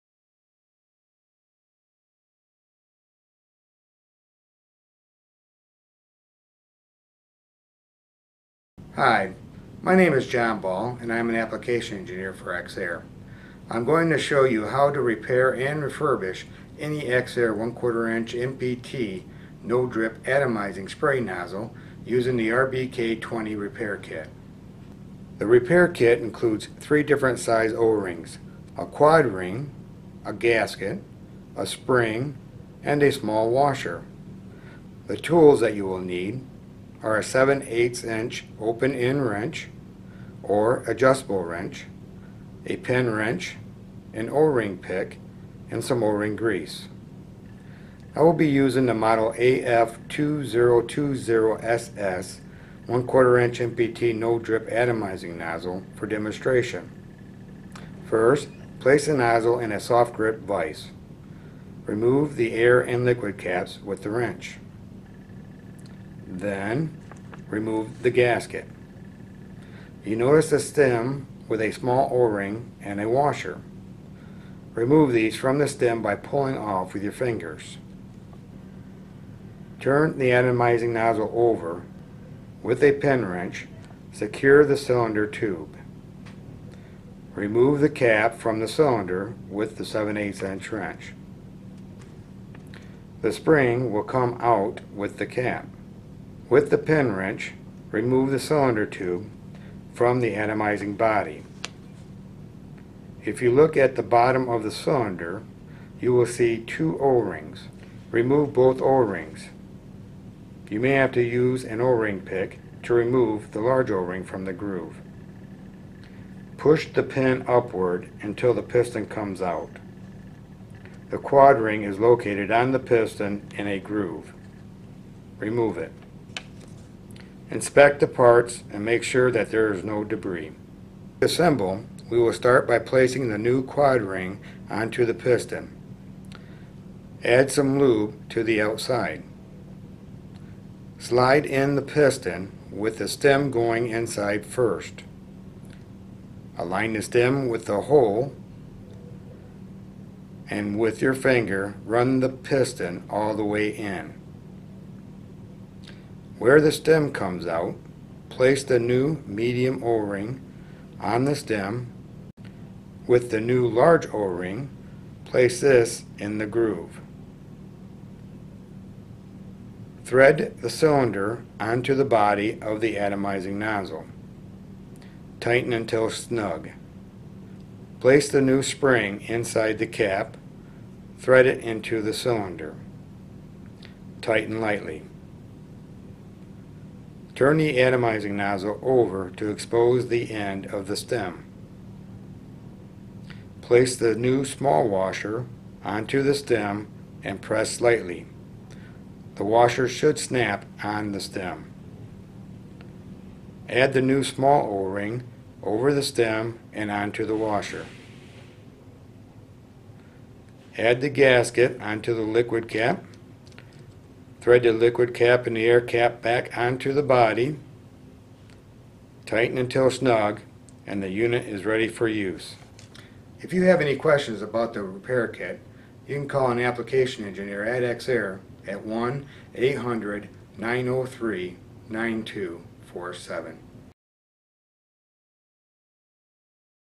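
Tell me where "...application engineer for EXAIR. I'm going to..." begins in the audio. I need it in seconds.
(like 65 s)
11 s.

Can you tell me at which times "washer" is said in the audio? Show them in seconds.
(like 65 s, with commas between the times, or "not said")
33 s, 73 s, 194 s, 199 s, 207 s.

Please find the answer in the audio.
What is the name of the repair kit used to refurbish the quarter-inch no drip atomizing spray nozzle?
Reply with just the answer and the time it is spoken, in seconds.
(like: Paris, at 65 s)
RBK20, at 22 s.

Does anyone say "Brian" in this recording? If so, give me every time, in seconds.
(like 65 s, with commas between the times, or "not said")
not said.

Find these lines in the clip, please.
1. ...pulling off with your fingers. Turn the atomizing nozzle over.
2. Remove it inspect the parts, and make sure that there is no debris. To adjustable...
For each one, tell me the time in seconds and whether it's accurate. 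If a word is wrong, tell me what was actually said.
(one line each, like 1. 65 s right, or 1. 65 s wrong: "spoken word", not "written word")
1. 76 s right
2. 125 s wrong: "assemble", not "adjustable".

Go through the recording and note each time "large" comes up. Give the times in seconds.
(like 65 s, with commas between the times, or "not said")
113 s, 163 s.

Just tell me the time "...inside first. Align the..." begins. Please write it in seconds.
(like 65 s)
143 s.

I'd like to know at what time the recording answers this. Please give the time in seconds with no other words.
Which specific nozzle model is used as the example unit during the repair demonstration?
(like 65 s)
49 s.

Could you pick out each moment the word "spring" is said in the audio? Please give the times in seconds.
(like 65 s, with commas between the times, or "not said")
31 s, 93 s, 178 s.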